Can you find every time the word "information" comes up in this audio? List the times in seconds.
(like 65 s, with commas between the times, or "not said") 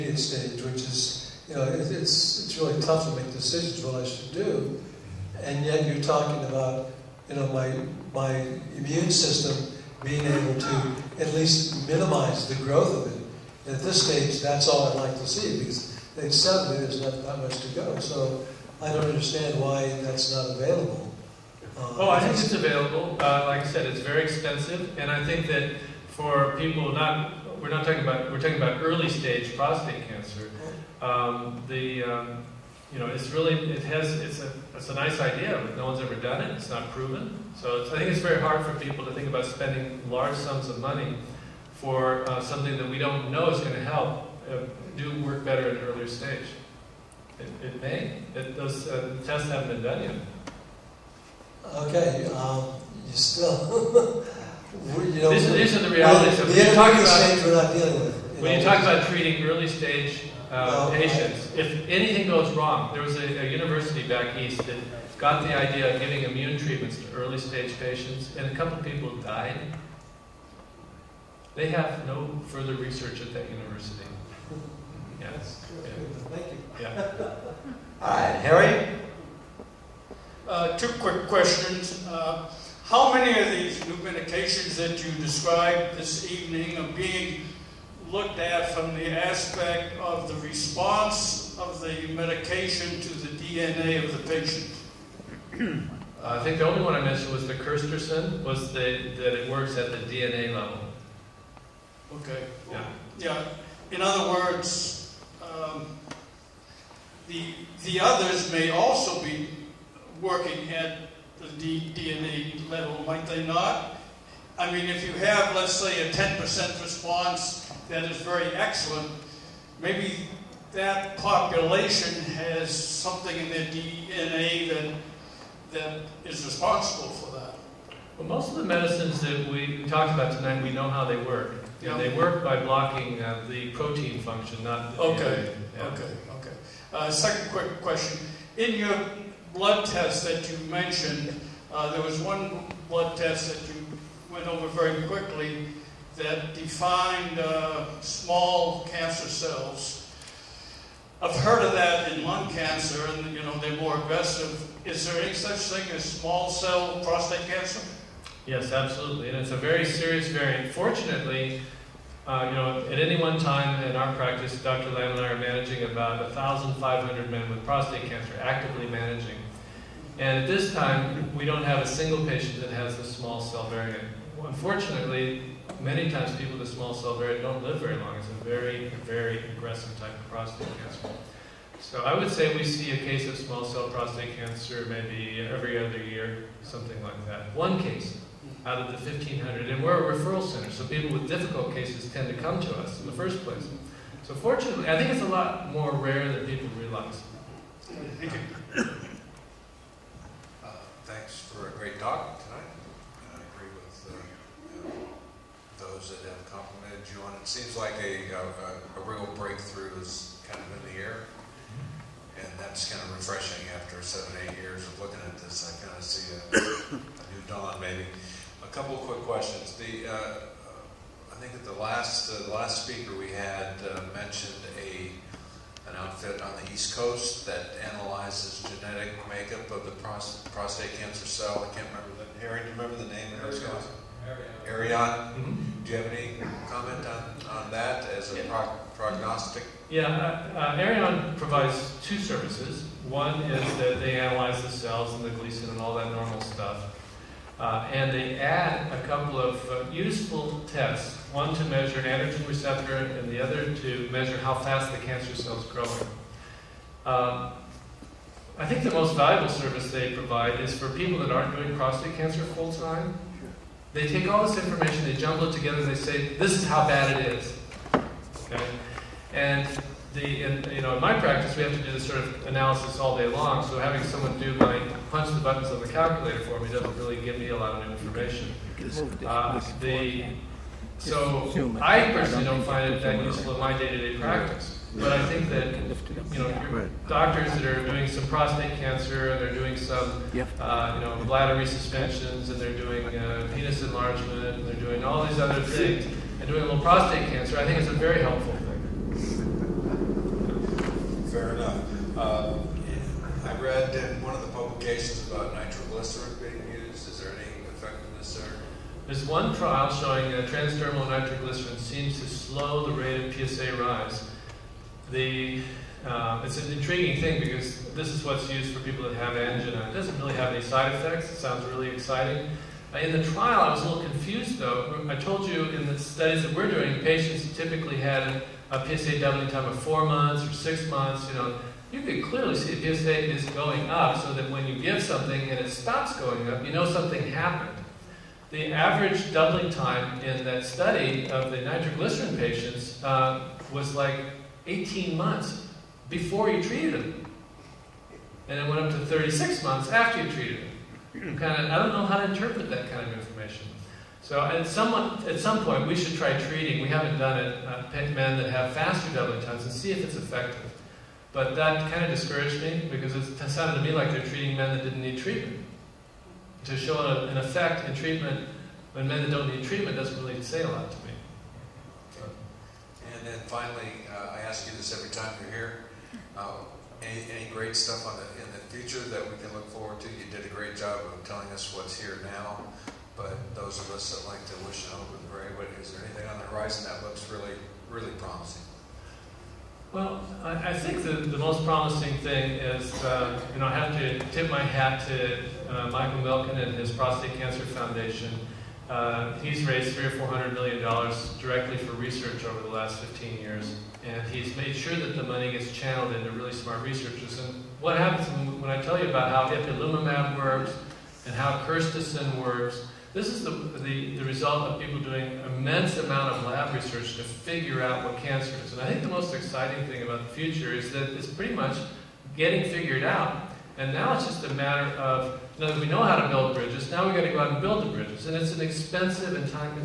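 264 s, 277 s, 353 s.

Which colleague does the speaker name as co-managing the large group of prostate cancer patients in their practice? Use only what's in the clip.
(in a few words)
Dr. Lamb.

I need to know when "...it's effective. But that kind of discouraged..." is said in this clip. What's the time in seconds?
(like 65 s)
360 s.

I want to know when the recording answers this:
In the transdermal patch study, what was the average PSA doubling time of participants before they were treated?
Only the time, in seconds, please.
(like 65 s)
344 s.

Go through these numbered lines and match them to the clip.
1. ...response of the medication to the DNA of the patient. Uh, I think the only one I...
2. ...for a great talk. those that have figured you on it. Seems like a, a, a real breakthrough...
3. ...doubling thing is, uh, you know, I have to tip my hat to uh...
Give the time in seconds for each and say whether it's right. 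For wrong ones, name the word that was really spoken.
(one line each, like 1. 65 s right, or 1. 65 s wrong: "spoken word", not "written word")
1. 90 s right
2. 201 s wrong: "complimented", not "figured"
3. 391 s wrong: "promising", not "doubling".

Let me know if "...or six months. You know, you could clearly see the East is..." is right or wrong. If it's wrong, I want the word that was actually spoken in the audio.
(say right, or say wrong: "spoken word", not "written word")
wrong: "PSA", not "East".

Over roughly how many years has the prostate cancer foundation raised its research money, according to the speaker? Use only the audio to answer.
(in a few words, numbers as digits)
15 years.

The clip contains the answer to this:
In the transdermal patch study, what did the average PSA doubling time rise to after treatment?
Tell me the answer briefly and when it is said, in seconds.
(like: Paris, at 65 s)
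36 months, at 349 s.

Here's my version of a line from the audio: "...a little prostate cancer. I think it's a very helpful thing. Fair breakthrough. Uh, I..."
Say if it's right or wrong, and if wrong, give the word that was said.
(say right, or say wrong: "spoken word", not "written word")
wrong: "enough", not "breakthrough".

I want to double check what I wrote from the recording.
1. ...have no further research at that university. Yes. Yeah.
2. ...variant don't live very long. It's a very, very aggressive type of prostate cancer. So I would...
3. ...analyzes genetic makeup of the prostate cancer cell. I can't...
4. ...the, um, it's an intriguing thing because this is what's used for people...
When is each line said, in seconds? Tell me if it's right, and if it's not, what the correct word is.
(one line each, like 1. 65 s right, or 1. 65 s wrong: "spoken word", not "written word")
1. 71 s right
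2. 177 s right
3. 227 s right
4. 315 s right.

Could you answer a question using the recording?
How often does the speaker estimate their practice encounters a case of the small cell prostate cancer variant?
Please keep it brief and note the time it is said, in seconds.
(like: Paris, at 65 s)
Every other year, at 185 s.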